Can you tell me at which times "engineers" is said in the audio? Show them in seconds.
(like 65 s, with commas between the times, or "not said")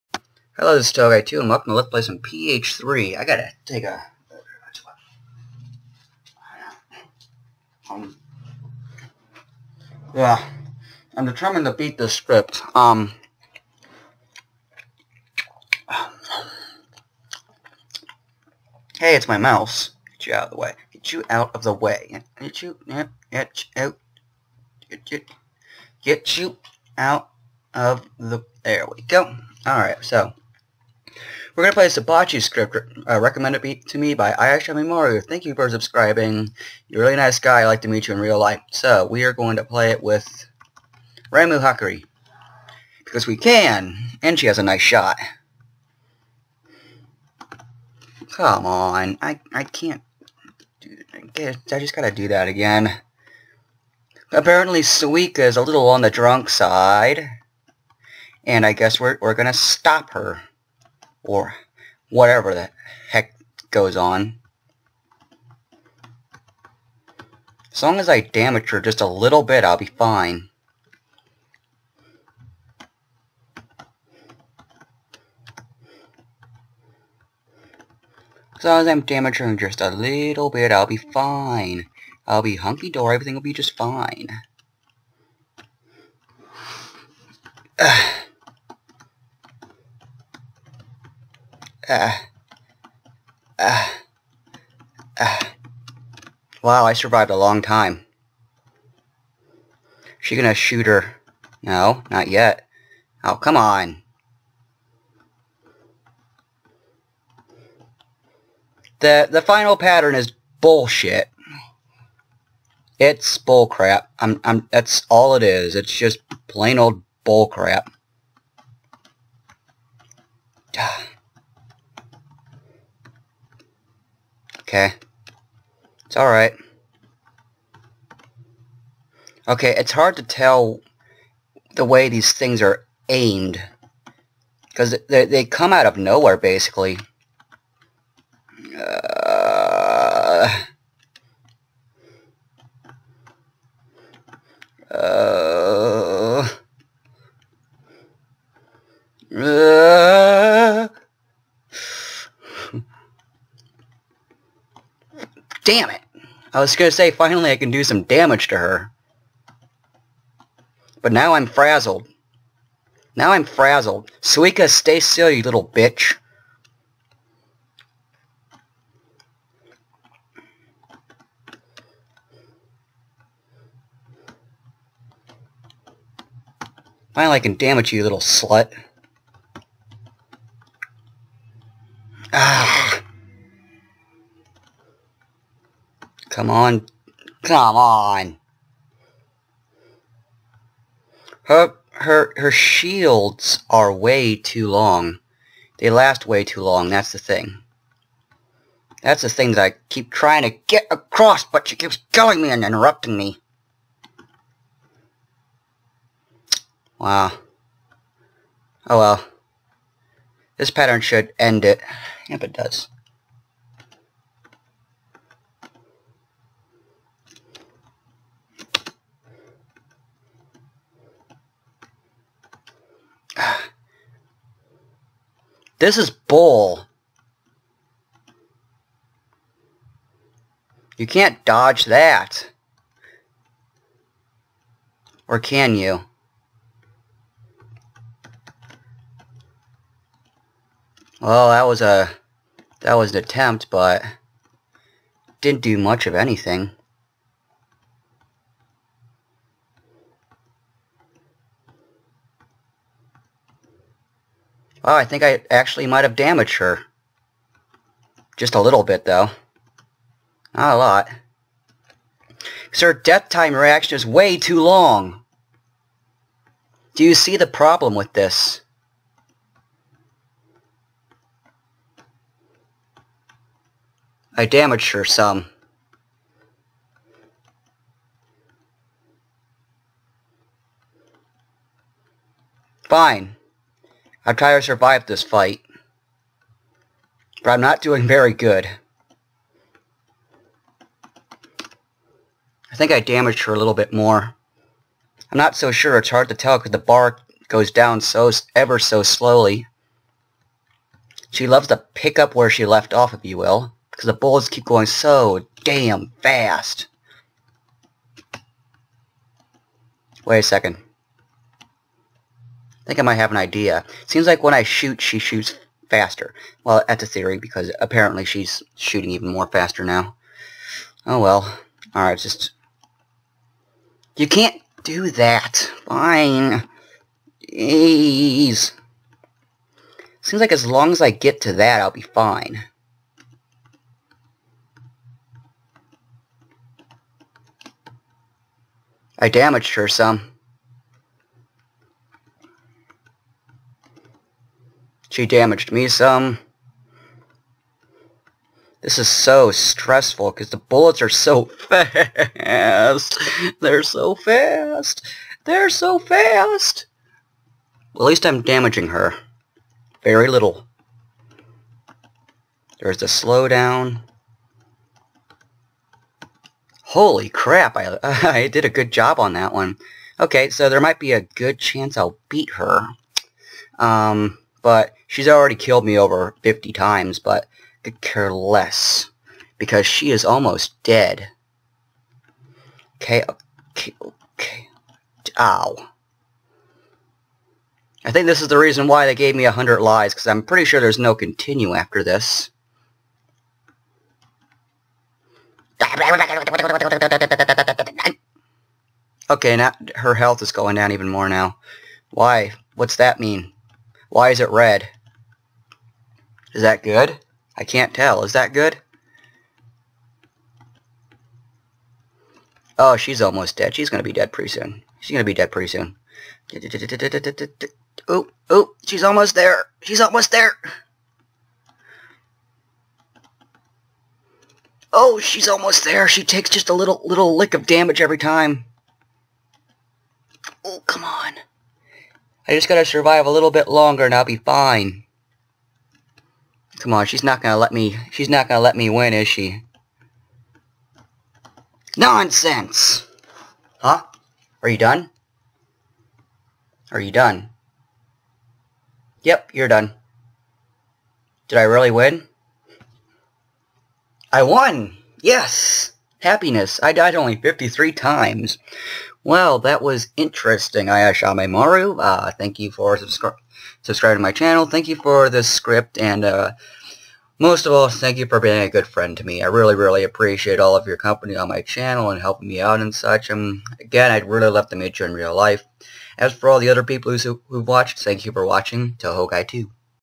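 not said.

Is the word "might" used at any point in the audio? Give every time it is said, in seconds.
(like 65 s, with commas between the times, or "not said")
255 s, 313 s, 370 s.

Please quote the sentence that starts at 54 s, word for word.
Apparently, Suika is a little on the drunk side.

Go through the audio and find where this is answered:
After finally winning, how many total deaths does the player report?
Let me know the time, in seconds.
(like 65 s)
457 s.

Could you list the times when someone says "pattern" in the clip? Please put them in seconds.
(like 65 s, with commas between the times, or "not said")
109 s, 210 s.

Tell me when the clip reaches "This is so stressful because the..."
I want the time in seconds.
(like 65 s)
348 s.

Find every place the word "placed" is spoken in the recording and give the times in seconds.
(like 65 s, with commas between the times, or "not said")
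not said.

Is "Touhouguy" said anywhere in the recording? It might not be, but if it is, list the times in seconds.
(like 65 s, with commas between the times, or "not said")
0 s, 478 s.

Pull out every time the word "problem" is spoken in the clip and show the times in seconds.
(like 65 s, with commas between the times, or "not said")
267 s.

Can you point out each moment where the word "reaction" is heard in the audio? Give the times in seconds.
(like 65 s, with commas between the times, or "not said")
263 s.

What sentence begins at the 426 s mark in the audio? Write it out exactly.
She takes just a little little lick of damage every time.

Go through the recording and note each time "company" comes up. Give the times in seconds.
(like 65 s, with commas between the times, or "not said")
470 s.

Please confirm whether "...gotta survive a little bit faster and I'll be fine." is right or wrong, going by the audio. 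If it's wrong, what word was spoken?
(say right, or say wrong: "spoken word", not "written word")
wrong: "longer", not "faster".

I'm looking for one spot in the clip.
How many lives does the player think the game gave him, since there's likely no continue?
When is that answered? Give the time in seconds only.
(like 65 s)
389 s.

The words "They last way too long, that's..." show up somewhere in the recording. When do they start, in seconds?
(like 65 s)
195 s.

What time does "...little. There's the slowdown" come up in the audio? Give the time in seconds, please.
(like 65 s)
360 s.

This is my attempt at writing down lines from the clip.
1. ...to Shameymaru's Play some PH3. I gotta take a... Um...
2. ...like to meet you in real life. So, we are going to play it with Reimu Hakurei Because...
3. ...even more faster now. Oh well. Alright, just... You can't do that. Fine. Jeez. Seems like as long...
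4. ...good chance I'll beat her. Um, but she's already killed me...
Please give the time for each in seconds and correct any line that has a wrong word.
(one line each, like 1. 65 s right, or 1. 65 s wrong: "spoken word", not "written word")
1. 1 s wrong: "Let", not "Shameymaru"
2. 37 s right
3. 319 s right
4. 371 s right.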